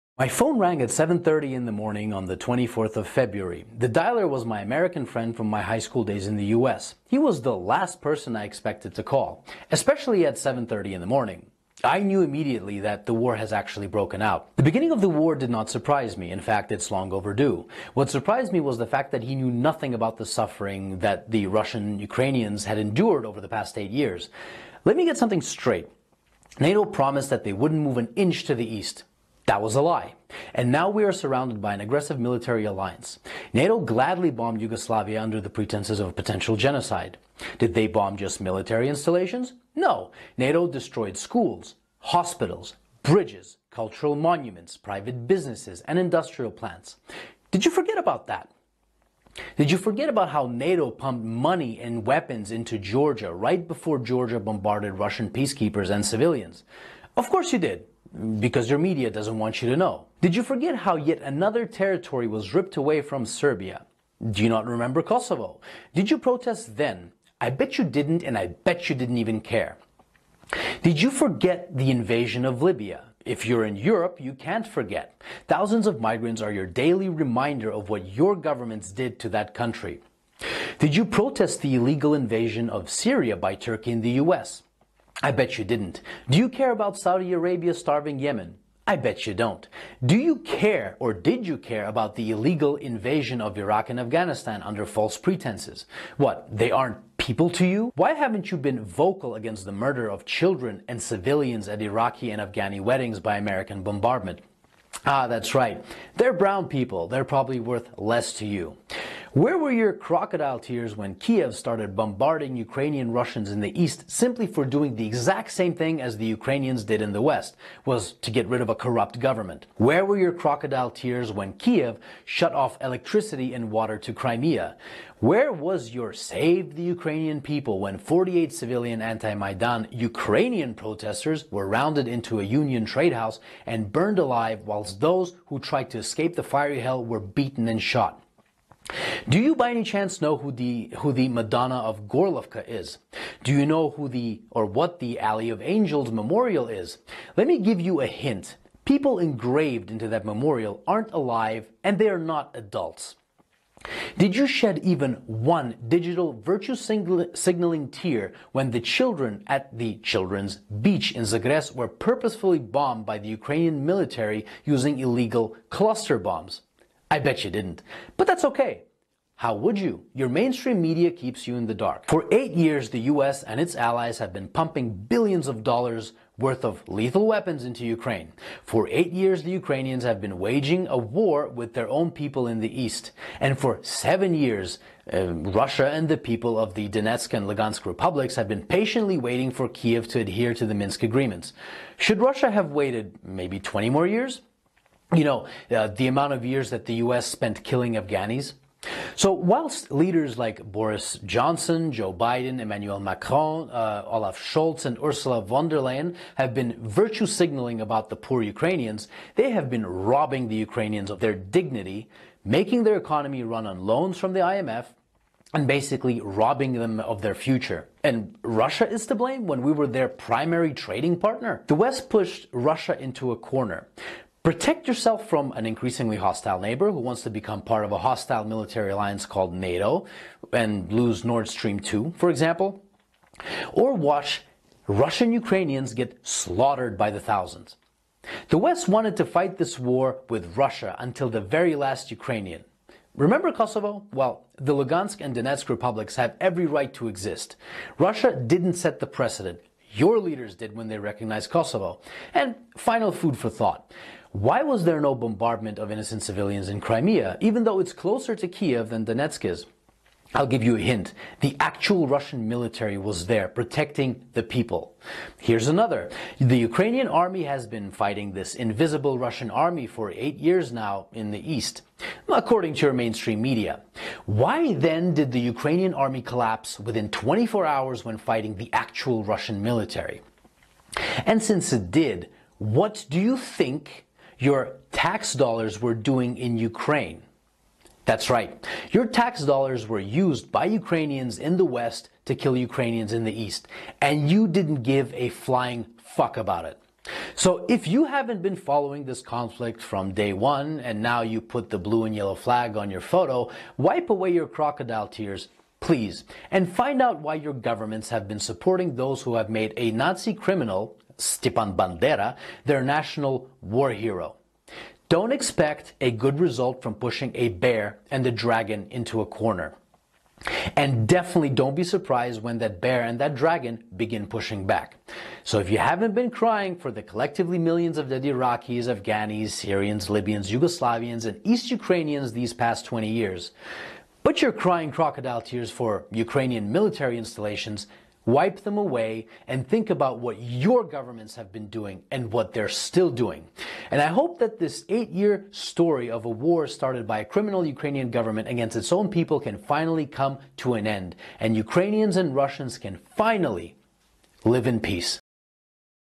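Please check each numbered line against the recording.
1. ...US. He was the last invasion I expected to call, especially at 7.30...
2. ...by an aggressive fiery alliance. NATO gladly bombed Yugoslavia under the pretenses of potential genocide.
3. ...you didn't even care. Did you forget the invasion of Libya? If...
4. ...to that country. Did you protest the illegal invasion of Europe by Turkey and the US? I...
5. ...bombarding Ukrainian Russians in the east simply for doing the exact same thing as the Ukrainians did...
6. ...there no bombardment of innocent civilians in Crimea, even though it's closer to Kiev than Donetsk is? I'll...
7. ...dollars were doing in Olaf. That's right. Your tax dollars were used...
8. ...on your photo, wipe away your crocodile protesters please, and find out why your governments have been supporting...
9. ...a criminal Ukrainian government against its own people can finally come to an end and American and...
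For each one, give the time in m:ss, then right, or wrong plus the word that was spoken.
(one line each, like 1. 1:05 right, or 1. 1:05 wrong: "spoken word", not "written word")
1. 0:06 wrong: "person", not "invasion"
2. 0:31 wrong: "military", not "fiery"
3. 1:08 right
4. 1:19 wrong: "Syria", not "Europe"
5. 1:51 right
6. 4:14 right
7. 4:45 wrong: "Ukraine", not "Olaf"
8. 5:02 wrong: "tears", not "protesters"
9. 5:47 wrong: "Ukrainians", not "American".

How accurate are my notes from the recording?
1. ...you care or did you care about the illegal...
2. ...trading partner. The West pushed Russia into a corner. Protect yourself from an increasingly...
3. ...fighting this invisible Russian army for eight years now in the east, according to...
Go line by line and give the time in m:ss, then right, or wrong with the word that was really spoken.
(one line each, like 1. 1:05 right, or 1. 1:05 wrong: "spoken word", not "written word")
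1. 1:30 right
2. 3:40 right
3. 4:27 right.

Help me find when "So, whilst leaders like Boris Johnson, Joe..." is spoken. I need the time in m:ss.
3:19.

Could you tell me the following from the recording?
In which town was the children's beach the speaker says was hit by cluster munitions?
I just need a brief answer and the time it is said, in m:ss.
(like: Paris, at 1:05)
Zugres, at 2:41.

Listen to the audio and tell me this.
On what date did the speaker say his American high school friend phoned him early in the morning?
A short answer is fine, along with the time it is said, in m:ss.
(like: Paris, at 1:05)
24 February, at 0:02.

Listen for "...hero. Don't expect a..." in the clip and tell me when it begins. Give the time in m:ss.
5:13.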